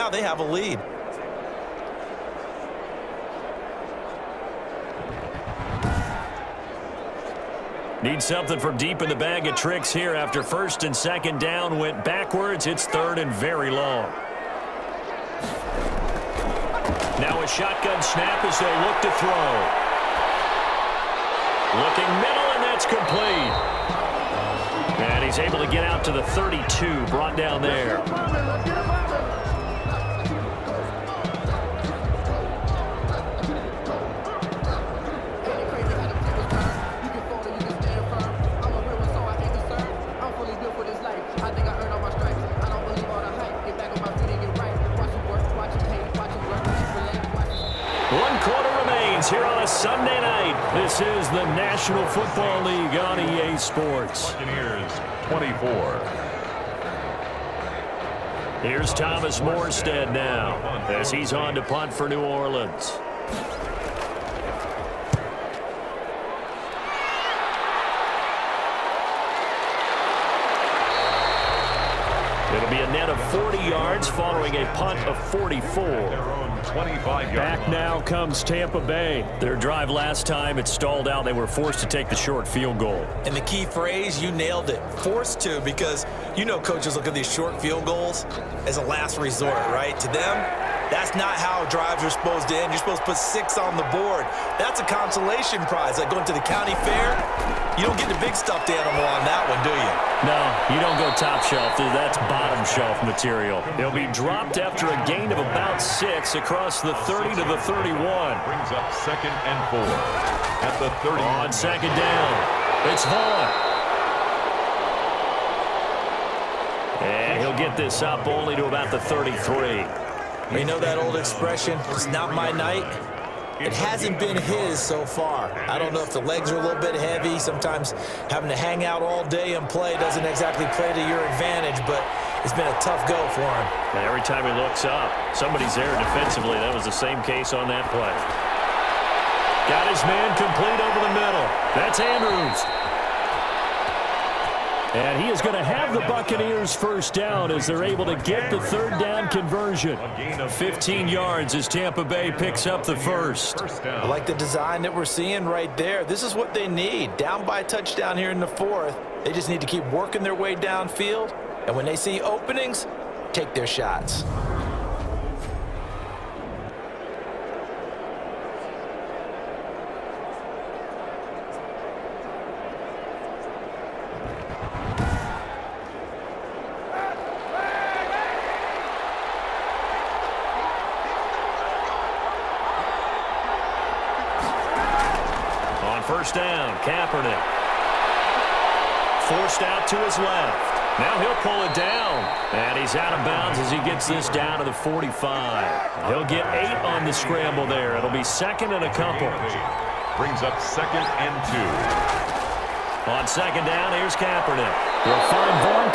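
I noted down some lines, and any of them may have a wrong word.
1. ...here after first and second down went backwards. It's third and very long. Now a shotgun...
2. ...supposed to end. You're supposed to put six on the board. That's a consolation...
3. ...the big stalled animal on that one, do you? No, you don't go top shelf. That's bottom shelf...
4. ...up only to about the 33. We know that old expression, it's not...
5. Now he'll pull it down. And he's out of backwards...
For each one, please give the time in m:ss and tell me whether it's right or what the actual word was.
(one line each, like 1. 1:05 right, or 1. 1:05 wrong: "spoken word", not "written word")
1. 0:09 right
2. 1:32 right
3. 1:38 wrong: "stuffed", not "stalled"
4. 1:58 right
5. 3:11 wrong: "bounds", not "backwards".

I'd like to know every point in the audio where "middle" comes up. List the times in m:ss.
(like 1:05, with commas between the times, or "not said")
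0:22, 2:21.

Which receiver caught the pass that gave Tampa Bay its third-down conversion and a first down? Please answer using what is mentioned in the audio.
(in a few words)
Andrews.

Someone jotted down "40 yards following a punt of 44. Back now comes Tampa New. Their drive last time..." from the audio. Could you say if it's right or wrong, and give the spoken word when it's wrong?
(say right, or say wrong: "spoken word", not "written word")
wrong: "Bay", not "New".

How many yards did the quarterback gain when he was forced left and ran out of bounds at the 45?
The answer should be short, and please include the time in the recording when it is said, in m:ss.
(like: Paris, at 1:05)
8, at 3:16.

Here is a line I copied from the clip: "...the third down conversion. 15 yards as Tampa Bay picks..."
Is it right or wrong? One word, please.
right.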